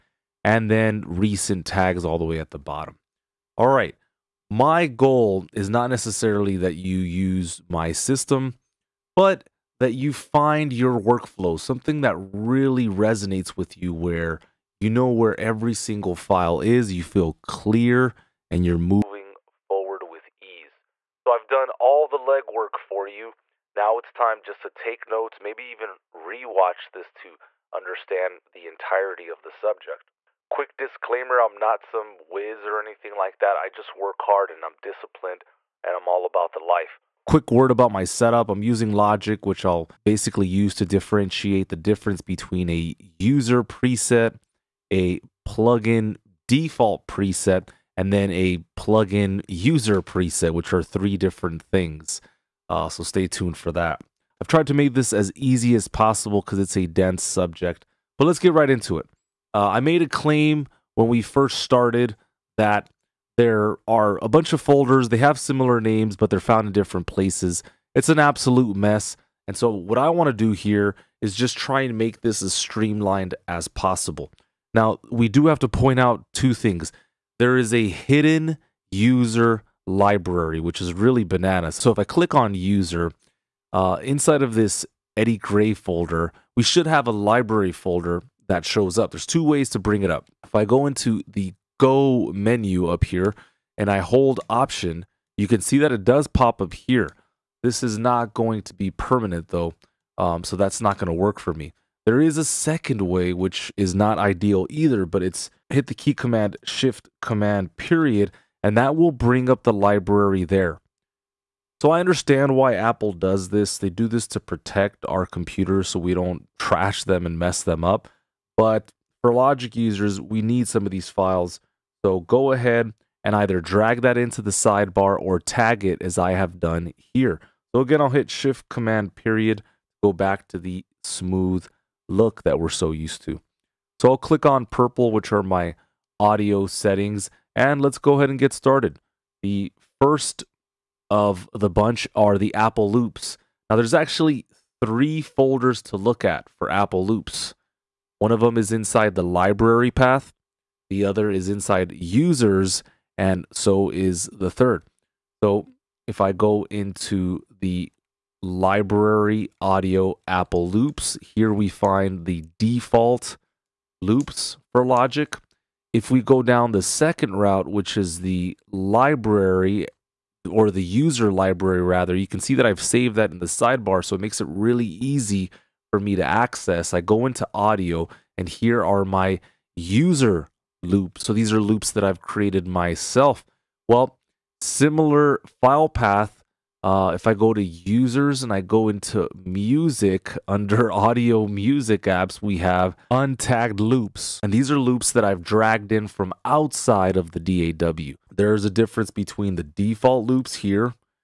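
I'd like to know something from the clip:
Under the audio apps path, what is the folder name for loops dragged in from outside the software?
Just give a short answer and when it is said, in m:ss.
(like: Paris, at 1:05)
Untagged loops, at 3:13.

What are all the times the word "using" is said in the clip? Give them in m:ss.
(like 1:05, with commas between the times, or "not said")
0:38.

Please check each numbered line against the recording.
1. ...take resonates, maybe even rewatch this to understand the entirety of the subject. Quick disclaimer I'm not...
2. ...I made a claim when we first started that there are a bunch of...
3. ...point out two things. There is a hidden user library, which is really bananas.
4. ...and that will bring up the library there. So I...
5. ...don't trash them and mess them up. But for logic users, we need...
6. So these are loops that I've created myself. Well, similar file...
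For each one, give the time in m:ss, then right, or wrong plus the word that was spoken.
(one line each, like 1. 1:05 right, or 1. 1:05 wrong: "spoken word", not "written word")
1. 0:24 wrong: "notes", not "resonates"
2. 0:59 right
3. 1:15 right
4. 1:48 right
5. 1:56 right
6. 3:01 right.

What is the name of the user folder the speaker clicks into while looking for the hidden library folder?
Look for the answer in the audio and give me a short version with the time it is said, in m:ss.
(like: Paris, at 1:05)
Eddie Grey, at 1:25.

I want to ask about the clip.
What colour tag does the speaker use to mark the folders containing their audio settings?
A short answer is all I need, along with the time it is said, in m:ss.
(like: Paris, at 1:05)
Purple, at 2:14.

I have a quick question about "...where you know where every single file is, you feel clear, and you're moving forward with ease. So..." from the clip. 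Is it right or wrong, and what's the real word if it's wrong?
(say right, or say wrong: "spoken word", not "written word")
right.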